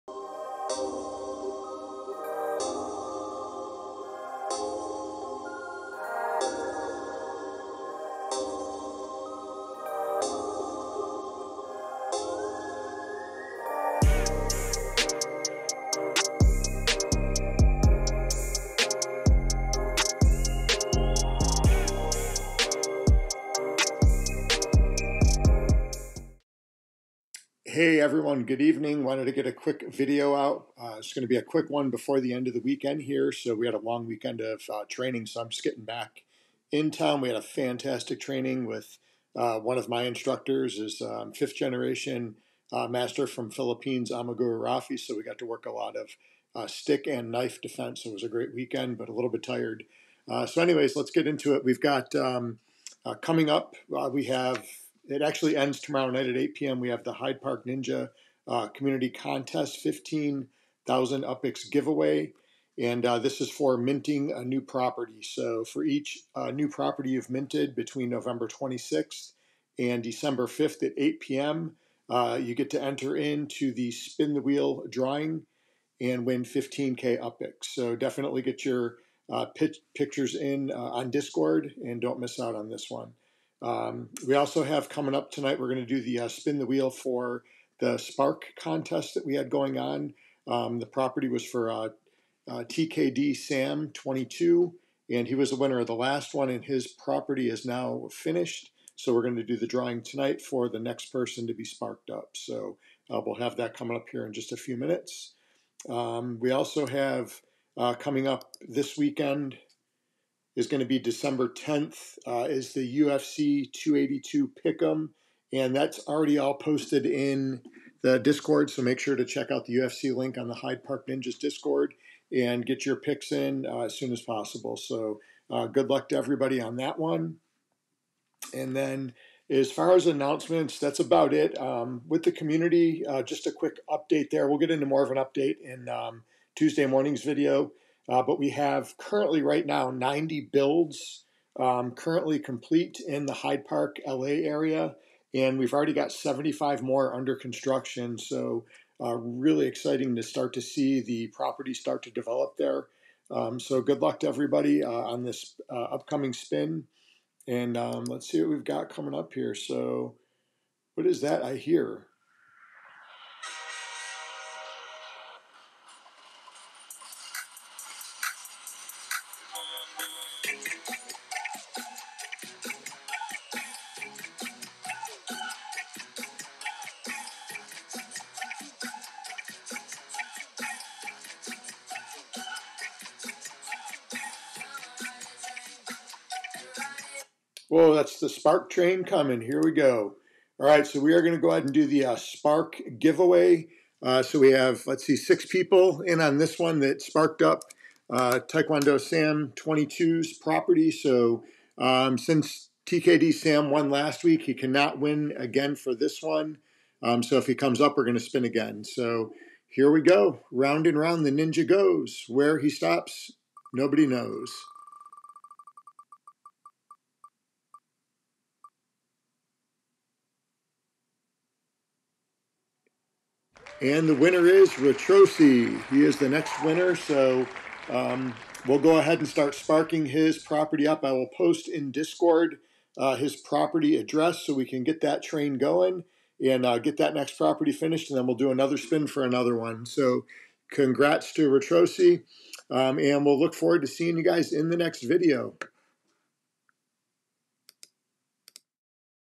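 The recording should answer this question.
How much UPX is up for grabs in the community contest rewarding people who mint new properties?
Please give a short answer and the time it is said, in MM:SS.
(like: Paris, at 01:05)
15,000, at 00:59.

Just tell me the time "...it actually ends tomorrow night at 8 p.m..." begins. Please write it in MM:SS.
00:55.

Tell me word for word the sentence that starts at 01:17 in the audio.
So definitely get your uh, pictures in uh, on Discord and don't miss out on this one.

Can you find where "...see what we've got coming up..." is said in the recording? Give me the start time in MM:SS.
02:38.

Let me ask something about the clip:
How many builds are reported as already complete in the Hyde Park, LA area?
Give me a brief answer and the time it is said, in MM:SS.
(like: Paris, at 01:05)
90, at 02:19.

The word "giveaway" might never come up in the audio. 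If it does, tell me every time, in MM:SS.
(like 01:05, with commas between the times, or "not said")
01:01, 03:12.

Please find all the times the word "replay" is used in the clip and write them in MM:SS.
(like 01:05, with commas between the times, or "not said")
not said.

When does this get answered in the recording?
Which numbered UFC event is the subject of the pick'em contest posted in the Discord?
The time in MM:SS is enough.
01:53.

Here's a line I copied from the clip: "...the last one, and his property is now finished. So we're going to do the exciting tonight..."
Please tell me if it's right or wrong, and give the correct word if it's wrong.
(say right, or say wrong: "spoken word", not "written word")
wrong: "drawing", not "exciting".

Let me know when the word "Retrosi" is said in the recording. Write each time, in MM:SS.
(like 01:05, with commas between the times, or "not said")
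03:44, 04:01.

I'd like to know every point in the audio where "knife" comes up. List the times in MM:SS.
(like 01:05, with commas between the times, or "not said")
00:47.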